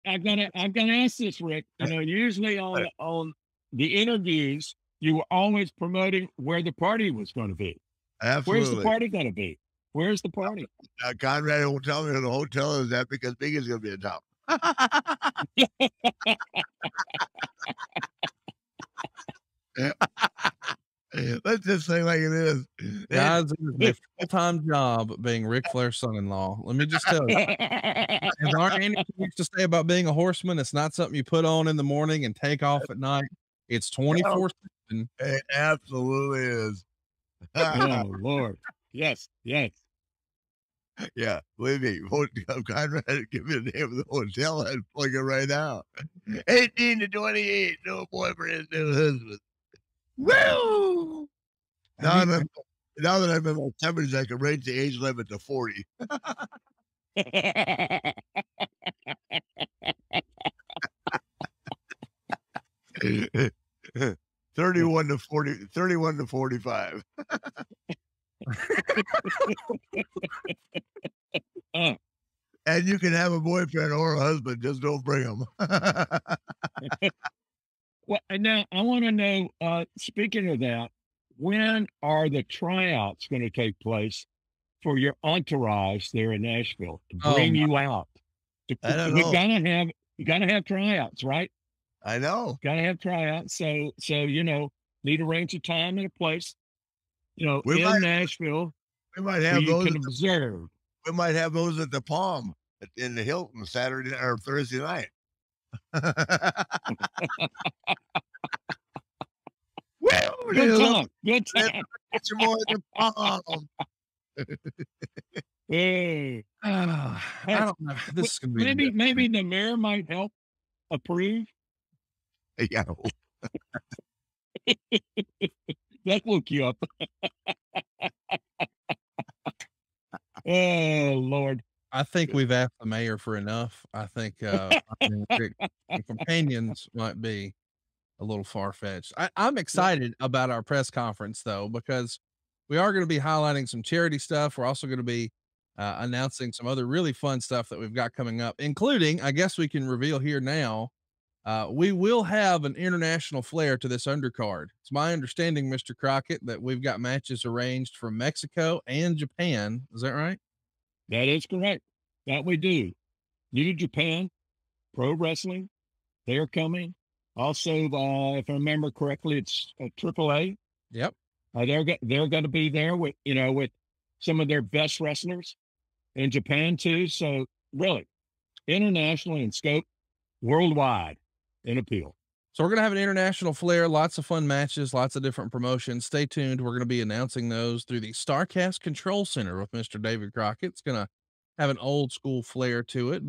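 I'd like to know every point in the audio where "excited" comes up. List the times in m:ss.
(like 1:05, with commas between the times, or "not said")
2:19.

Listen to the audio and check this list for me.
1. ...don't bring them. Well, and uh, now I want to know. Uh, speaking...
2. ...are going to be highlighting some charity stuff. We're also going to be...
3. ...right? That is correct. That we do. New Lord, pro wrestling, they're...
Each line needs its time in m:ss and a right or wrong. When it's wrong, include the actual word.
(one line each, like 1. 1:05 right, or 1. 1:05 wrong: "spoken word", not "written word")
1. 1:14 right
2. 2:22 right
3. 2:40 wrong: "Japan", not "Lord".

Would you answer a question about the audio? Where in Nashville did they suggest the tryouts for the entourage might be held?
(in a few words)
The Palm in the Hilton.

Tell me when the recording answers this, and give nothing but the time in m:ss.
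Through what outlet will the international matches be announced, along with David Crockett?
3:08.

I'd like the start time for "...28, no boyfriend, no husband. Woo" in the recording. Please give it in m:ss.
0:47.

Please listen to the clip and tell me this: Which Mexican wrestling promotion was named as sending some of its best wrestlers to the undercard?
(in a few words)
AAA.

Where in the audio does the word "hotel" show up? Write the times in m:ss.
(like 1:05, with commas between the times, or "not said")
0:12, 0:44.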